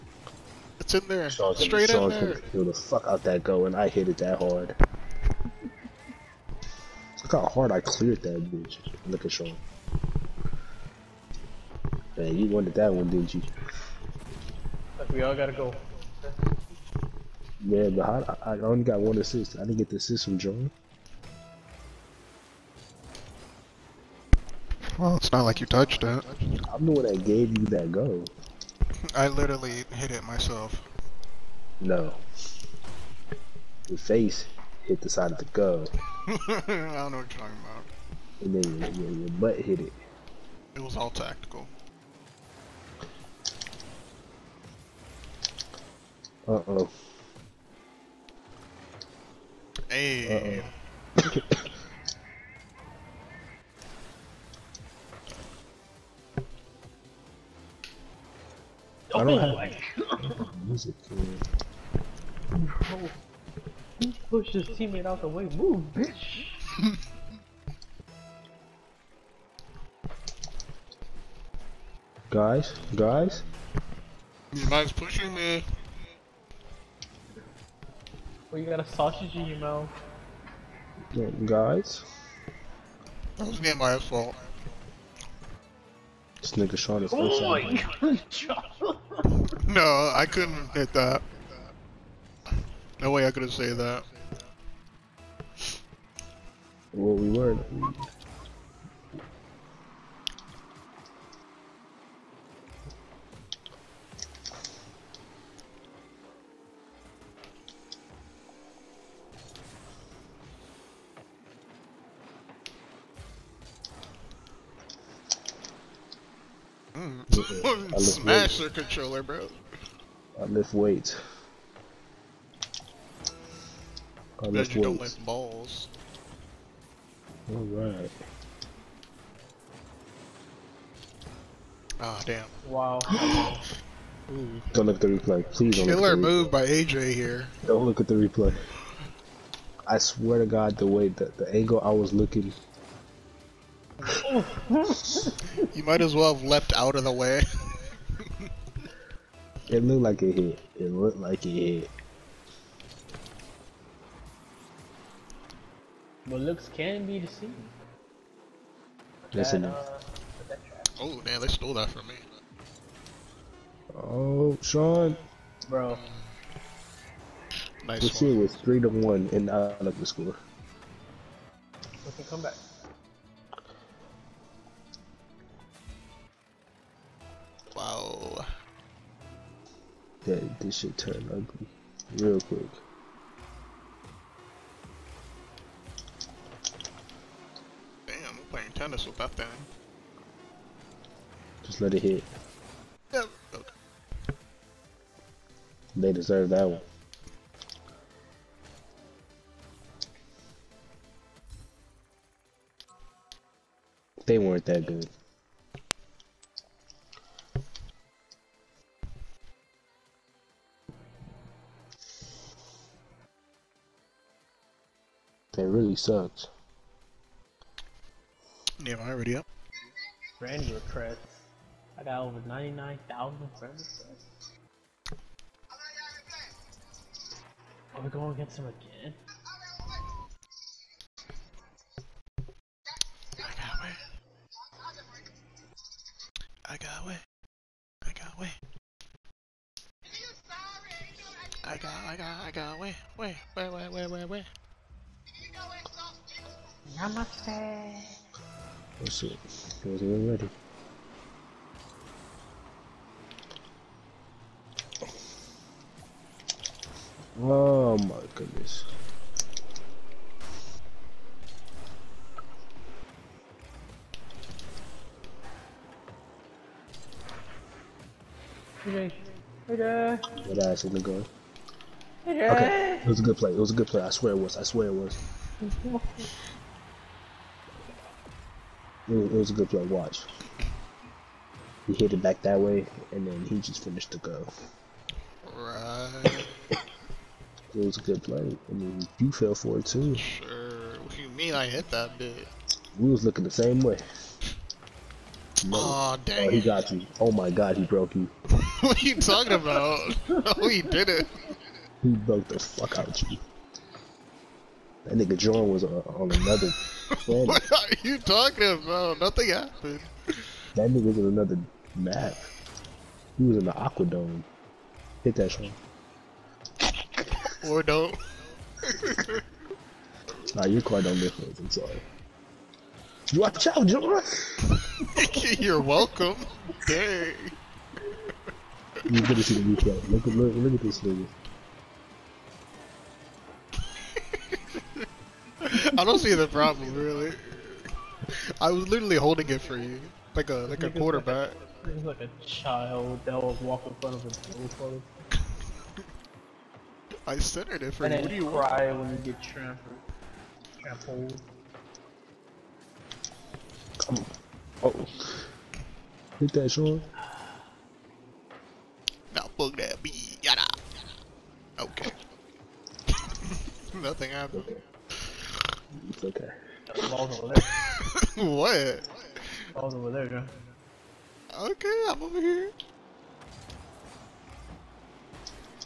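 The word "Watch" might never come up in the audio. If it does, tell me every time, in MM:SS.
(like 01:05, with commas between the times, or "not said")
04:39, 05:23.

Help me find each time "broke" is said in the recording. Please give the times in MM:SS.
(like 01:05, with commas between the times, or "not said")
04:57, 05:02.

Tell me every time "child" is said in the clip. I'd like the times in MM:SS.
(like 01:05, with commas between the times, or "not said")
05:42.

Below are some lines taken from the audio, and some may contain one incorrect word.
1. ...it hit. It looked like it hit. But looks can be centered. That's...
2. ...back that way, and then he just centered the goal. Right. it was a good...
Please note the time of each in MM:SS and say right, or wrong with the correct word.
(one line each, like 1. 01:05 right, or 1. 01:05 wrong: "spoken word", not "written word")
1. 02:30 wrong: "deceived", not "centered"
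2. 04:42 wrong: "finished", not "centered".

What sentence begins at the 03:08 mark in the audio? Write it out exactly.
Damn, I'm playing tennis with that thing.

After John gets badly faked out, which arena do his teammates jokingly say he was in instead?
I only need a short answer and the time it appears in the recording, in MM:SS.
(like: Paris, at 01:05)
Aquadome, at 05:13.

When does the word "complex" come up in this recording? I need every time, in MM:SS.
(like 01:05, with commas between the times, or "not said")
not said.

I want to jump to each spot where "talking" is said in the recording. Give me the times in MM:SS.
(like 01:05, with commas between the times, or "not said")
00:37, 04:59, 05:08.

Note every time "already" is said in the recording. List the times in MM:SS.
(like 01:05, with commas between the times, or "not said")
03:39, 04:10.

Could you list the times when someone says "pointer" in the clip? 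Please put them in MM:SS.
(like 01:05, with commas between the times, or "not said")
not said.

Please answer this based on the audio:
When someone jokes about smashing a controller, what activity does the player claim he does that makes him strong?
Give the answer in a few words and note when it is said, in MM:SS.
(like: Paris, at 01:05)
Lift weights, at 02:00.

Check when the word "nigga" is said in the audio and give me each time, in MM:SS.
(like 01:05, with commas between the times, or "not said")
01:26, 05:05, 05:10, 05:30.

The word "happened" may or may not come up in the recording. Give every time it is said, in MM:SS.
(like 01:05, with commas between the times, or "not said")
05:09, 06:04.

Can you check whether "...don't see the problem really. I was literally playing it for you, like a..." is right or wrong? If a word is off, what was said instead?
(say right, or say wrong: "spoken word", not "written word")
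wrong: "holding", not "playing".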